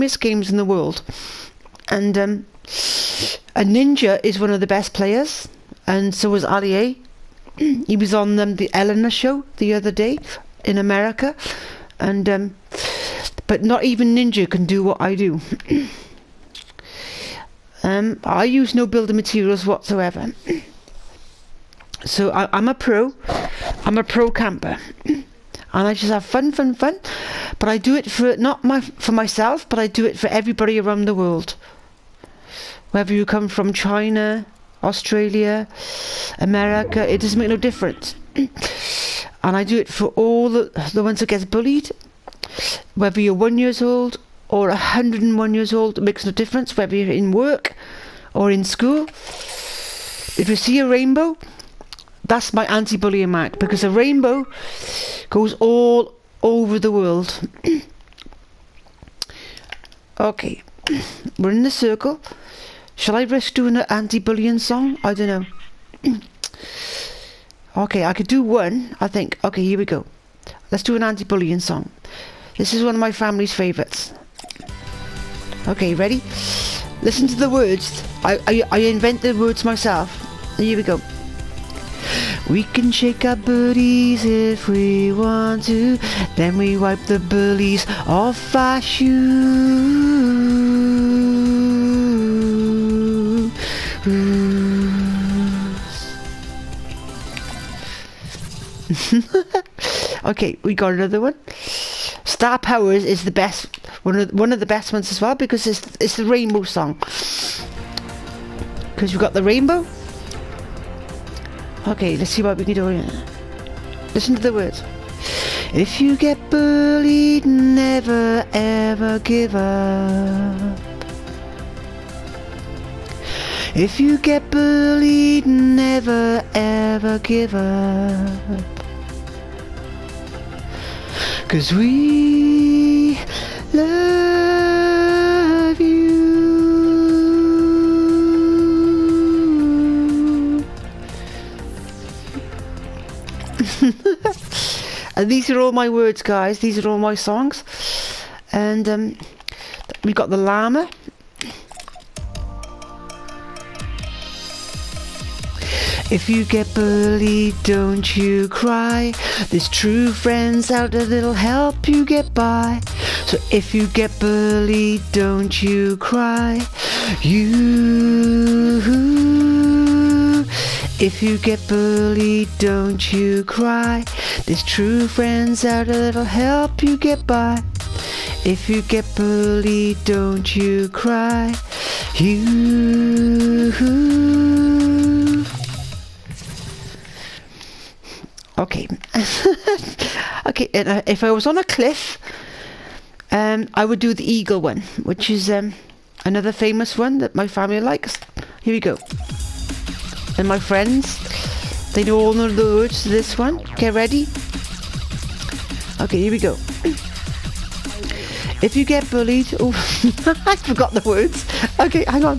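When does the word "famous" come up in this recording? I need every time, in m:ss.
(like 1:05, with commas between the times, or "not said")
3:16.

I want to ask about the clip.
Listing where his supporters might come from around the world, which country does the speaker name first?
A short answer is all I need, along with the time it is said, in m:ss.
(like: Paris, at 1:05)
China, at 0:33.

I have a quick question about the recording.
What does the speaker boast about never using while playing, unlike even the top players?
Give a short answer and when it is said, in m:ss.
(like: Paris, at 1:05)
Building materials, at 0:18.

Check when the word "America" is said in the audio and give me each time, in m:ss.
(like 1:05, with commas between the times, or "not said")
0:10, 0:36.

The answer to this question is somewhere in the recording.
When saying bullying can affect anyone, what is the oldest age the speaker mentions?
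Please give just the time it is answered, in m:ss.
0:44.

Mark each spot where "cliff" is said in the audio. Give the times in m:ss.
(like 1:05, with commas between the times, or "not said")
3:11.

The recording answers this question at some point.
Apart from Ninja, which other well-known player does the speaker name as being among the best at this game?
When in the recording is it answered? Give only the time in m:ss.
0:06.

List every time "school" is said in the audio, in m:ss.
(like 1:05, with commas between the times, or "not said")
0:48.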